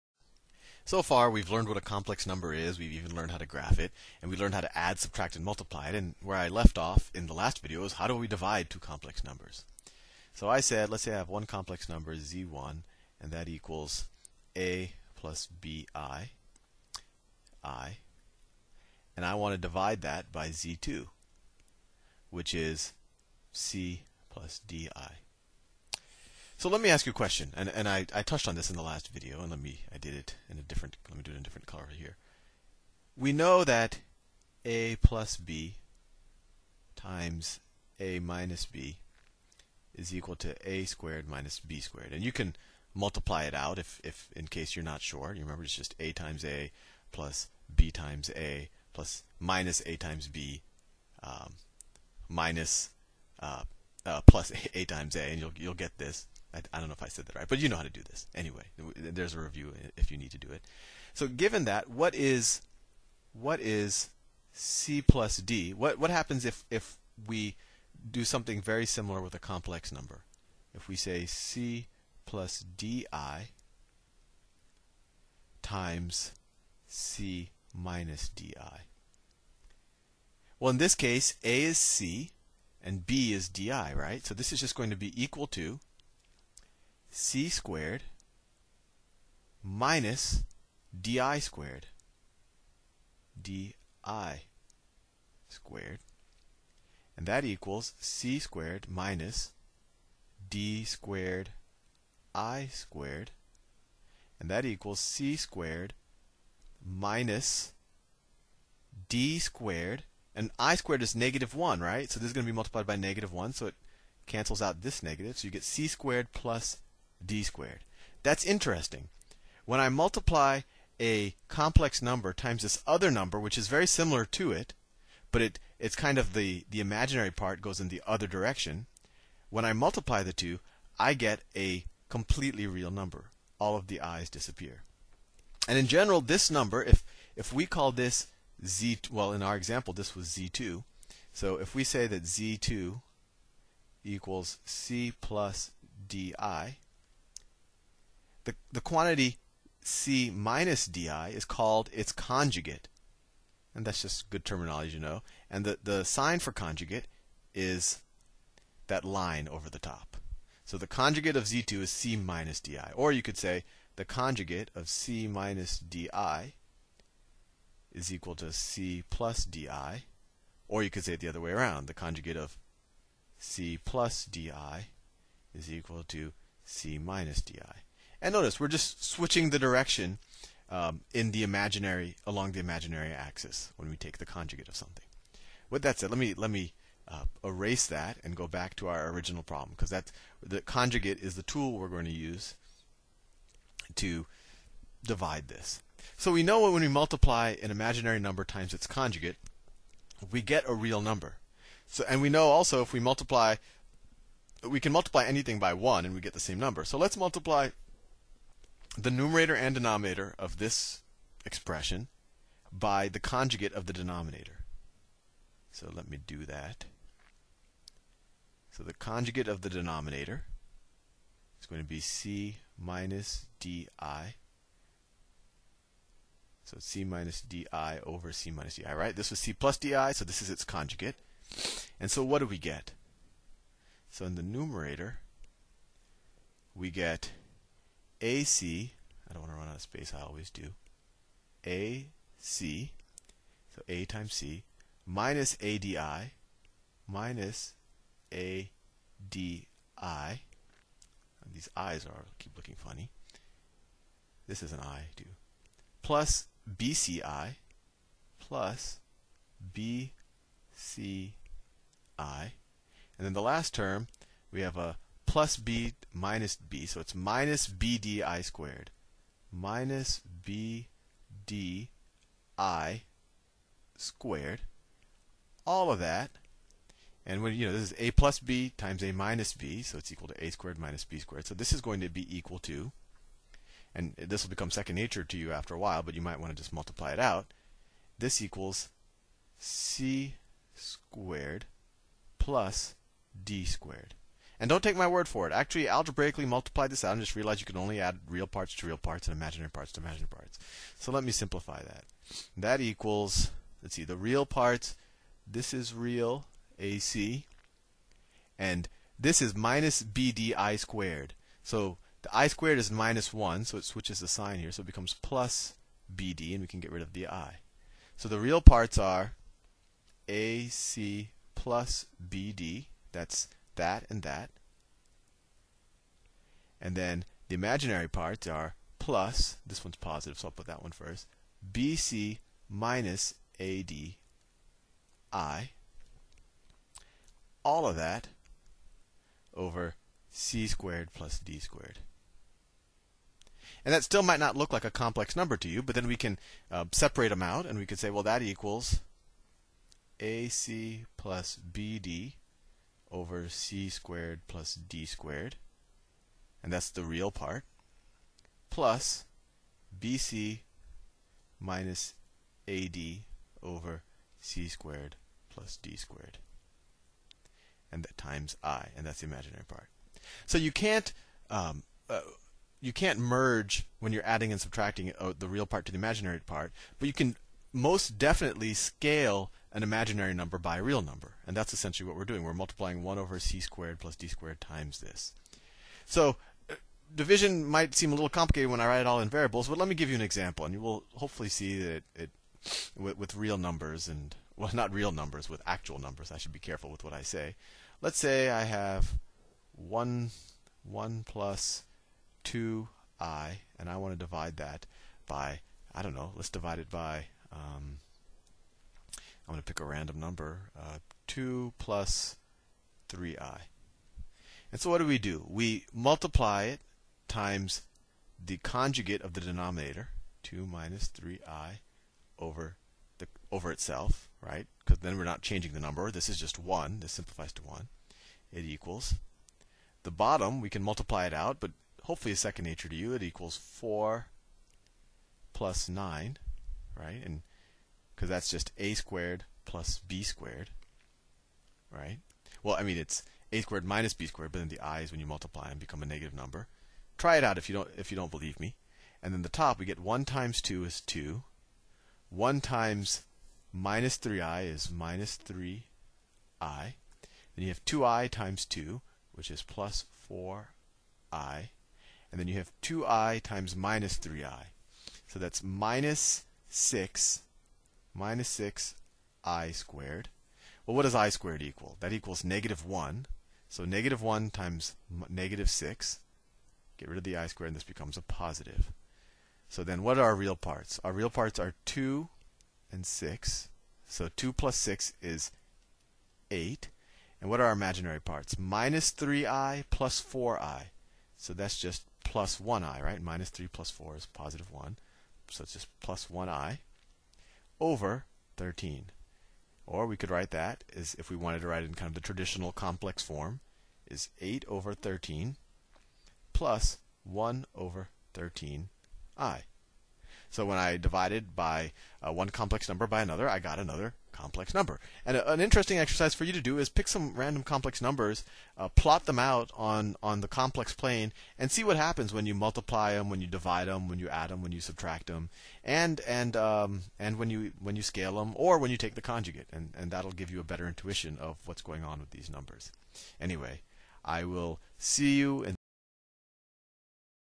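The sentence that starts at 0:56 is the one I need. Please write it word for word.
I, I, don't know if I said that right, but you know how to do this.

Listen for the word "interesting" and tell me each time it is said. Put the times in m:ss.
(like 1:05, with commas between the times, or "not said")
1:58, 8:35.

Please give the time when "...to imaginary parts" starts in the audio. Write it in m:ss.
4:59.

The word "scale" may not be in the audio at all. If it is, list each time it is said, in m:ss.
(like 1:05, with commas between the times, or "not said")
6:18, 8:48.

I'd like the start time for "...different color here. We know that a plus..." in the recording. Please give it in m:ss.
0:31.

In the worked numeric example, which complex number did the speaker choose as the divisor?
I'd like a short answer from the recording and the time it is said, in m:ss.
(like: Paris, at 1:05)
2 + 3i, at 6:51.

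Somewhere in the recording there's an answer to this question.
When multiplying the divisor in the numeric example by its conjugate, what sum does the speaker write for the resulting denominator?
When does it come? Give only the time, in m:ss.
7:13.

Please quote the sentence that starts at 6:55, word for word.
We multiply it times the conjugate of the denominator, 2 minus 3i, over the over itself, right?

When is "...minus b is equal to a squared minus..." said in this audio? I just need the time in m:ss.
0:38.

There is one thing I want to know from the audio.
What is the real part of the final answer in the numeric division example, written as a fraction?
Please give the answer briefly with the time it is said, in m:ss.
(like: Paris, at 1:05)
8/13, at 8:24.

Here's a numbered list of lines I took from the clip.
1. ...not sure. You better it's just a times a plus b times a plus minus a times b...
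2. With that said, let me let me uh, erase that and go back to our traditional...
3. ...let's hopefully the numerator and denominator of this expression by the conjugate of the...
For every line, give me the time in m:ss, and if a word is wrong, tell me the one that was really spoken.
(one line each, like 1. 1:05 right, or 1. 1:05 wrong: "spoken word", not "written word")
1. 0:44 wrong: "remember", not "better"
2. 3:05 wrong: "original", not "traditional"
3. 3:26 wrong: "multiply", not "hopefully".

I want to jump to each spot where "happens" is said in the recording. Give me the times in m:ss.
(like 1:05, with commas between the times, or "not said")
1:06, 8:41.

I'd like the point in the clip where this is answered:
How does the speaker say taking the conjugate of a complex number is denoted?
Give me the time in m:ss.
2:38.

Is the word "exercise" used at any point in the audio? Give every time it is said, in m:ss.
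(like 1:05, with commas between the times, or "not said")
8:35.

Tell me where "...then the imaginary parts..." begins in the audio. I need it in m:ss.
5:26.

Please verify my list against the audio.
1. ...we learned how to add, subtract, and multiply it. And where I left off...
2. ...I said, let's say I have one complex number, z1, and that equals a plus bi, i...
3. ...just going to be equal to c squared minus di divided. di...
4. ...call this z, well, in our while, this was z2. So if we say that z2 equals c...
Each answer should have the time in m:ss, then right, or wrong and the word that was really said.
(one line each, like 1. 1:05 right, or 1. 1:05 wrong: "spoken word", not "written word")
1. 0:04 right
2. 0:10 right
3. 1:24 wrong: "squared", not "divided"
4. 2:17 wrong: "example", not "while".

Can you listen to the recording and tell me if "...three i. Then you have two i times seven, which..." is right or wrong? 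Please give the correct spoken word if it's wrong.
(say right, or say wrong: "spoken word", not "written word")
wrong: "two", not "seven".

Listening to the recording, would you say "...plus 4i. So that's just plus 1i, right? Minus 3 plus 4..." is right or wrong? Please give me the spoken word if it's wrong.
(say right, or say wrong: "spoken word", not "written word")
right.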